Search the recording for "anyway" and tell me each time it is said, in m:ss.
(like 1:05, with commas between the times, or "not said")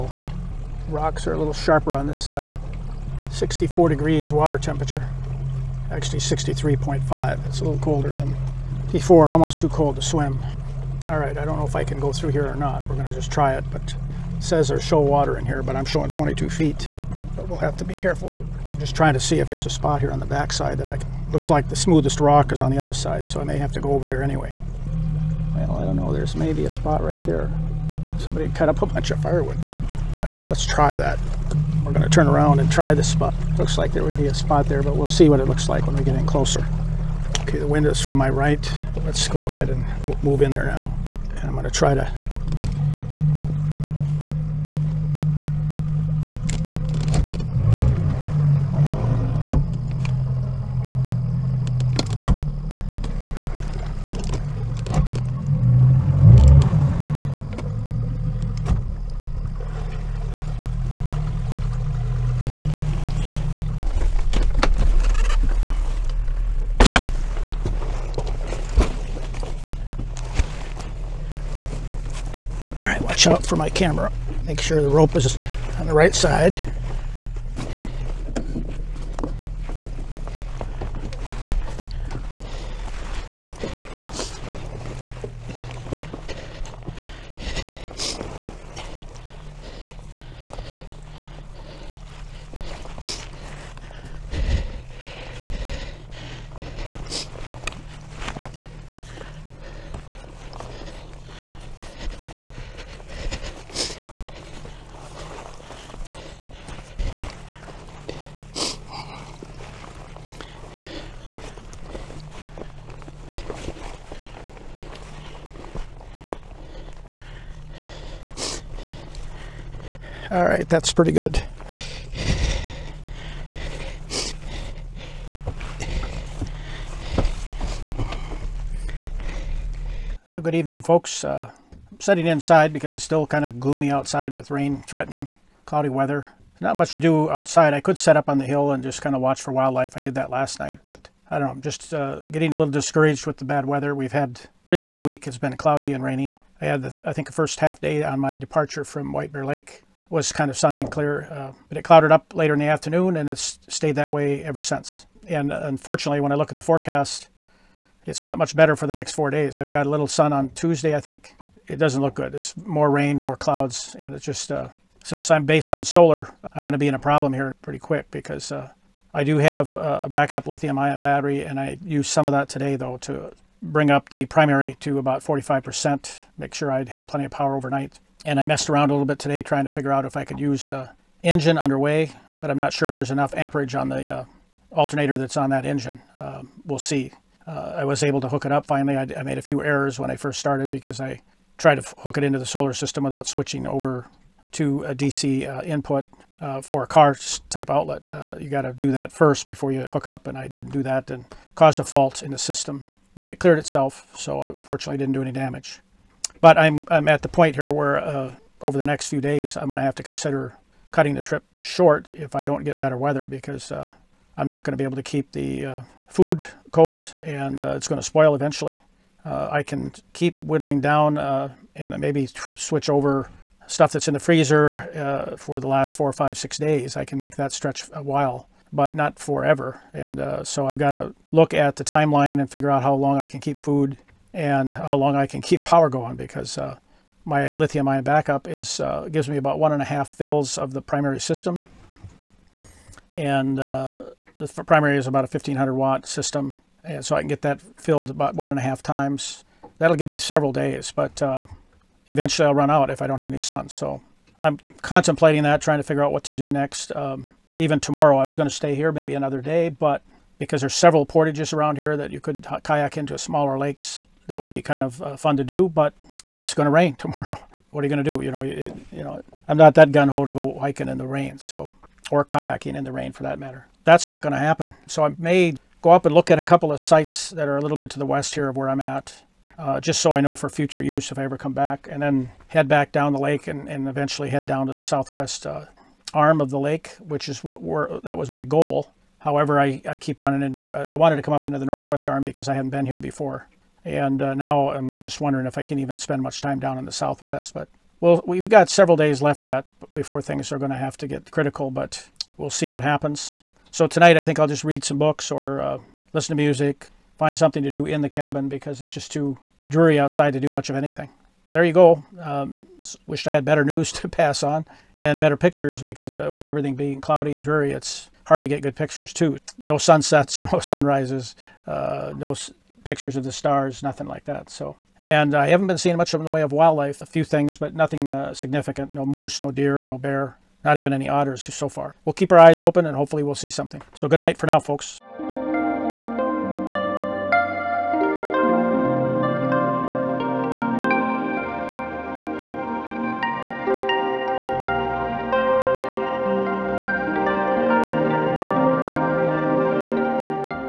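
0:24.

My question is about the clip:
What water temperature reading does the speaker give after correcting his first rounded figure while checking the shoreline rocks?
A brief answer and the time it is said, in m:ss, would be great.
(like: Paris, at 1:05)
63.5 degrees, at 0:06.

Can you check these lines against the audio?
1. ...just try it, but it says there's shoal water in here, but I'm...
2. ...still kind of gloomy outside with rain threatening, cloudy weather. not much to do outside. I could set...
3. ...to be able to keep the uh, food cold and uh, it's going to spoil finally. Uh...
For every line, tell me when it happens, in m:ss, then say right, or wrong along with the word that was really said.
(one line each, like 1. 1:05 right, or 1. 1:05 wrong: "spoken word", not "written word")
1. 0:13 right
2. 2:13 right
3. 3:34 wrong: "eventually", not "finally".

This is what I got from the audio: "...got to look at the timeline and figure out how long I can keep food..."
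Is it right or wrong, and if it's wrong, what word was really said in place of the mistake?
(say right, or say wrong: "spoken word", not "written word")
right.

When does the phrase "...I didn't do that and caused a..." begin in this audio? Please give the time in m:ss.
3:20.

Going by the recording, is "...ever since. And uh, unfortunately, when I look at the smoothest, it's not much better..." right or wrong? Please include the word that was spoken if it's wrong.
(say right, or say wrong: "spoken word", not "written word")
wrong: "forecast", not "smoothest".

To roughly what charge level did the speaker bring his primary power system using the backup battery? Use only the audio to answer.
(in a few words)
45%.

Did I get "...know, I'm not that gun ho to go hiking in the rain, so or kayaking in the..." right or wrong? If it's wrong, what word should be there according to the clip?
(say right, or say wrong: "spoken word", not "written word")
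right.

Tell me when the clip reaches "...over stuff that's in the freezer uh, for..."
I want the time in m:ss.
3:42.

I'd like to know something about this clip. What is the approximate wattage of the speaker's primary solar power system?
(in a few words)
1500 watts.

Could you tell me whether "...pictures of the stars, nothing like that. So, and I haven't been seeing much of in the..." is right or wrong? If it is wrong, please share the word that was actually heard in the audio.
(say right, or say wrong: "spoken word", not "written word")
right.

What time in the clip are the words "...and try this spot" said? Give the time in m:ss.
0:32.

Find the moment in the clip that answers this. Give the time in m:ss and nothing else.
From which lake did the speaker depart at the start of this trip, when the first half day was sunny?
2:29.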